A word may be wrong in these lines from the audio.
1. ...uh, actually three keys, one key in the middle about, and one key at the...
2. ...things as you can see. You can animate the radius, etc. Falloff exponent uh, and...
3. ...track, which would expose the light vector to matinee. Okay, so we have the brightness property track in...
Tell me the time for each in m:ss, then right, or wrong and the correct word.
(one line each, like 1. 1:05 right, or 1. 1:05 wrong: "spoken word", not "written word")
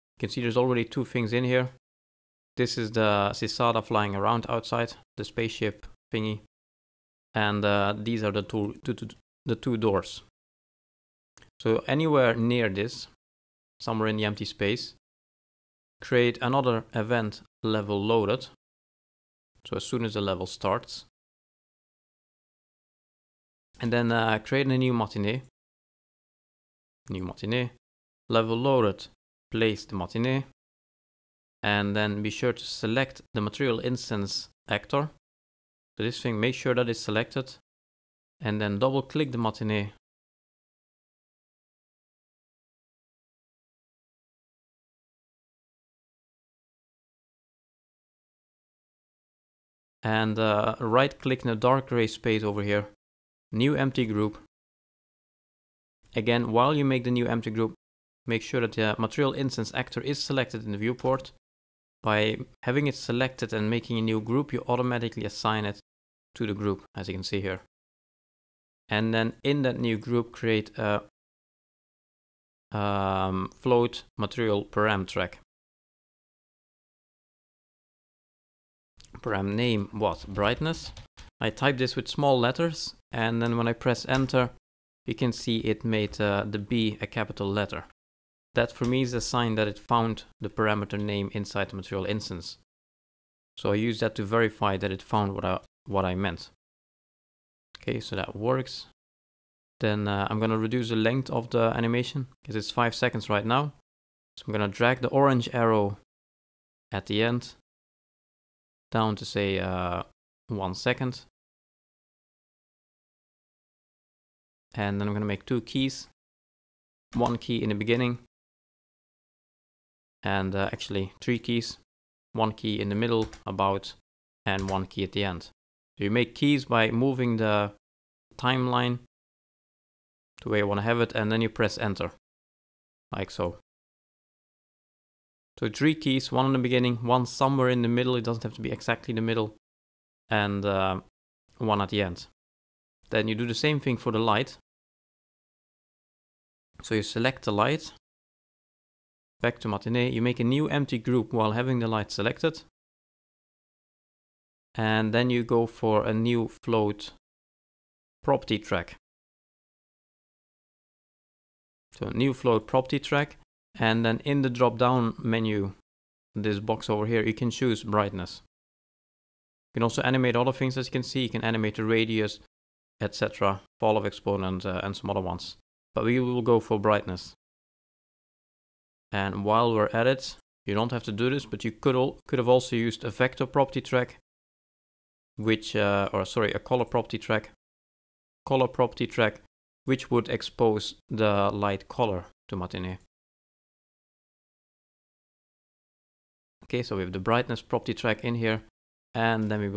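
1. 2:00 right
2. 2:50 right
3. 3:09 wrong: "color", not "vector".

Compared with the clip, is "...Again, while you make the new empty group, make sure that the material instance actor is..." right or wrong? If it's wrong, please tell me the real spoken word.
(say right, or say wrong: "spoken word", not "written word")
right.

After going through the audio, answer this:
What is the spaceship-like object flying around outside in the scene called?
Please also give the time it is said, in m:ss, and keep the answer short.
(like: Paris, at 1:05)
Cicada, at 0:03.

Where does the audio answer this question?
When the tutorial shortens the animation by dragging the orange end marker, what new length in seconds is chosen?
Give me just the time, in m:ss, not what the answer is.
1:50.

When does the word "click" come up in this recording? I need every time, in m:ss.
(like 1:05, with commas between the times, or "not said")
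0:39, 0:51.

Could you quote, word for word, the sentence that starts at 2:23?
Then you do the same thing for the light.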